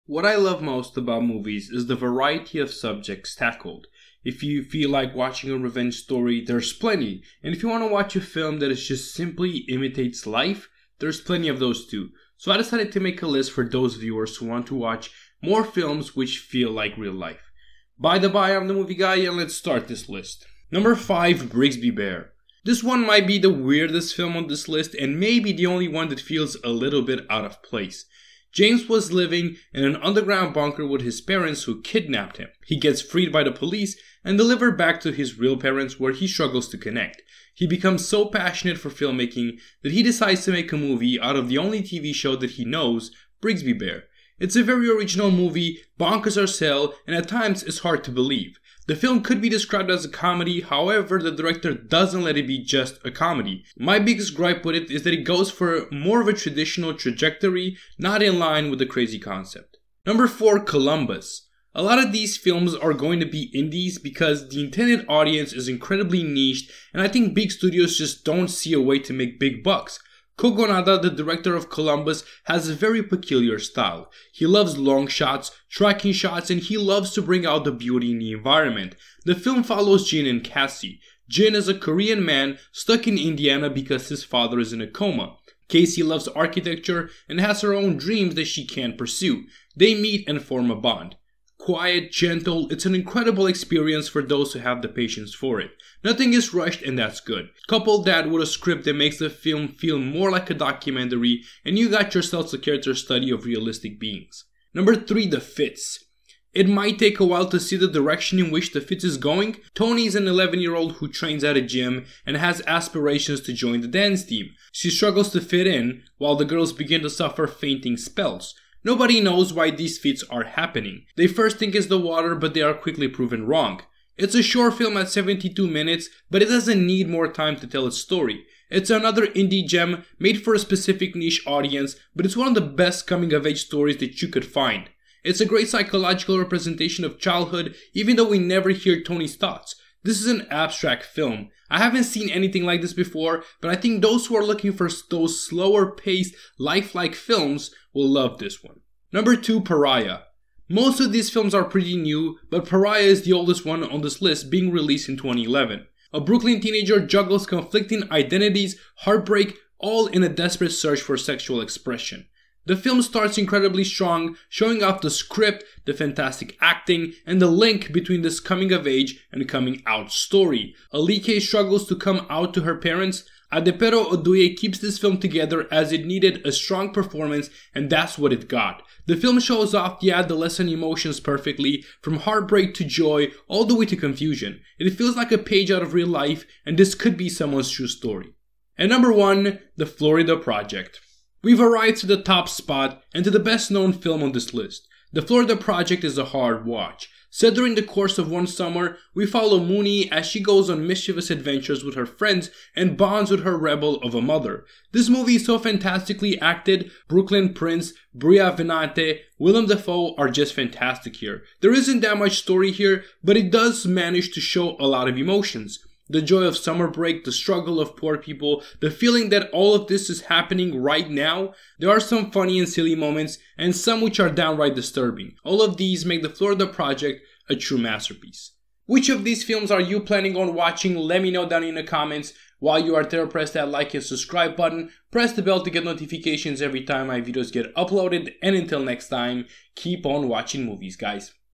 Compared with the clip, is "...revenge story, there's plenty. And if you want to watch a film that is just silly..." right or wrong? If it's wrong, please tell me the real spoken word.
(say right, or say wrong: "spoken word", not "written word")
wrong: "simply", not "silly".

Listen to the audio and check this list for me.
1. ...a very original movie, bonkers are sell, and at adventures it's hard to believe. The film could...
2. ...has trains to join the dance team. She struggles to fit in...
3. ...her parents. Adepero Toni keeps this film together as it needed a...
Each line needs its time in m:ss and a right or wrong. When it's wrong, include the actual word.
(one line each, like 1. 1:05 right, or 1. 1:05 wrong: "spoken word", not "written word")
1. 0:44 wrong: "times", not "adventures"
2. 1:52 wrong: "aspirations", not "trains"
3. 2:52 wrong: "Oduye", not "Toni".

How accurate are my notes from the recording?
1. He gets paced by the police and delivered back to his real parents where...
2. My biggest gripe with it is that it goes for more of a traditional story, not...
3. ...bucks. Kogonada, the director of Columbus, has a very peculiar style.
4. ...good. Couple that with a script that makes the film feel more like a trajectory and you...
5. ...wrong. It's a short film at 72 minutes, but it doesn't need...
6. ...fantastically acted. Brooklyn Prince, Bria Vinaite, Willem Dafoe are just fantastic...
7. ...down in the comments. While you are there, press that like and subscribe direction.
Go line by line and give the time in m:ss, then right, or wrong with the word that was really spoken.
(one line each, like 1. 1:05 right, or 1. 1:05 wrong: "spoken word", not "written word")
1. 0:32 wrong: "freed", not "paced"
2. 0:53 wrong: "trajectory", not "story"
3. 1:09 right
4. 1:37 wrong: "documentary", not "trajectory"
5. 2:03 right
6. 3:25 right
7. 3:51 wrong: "button", not "direction".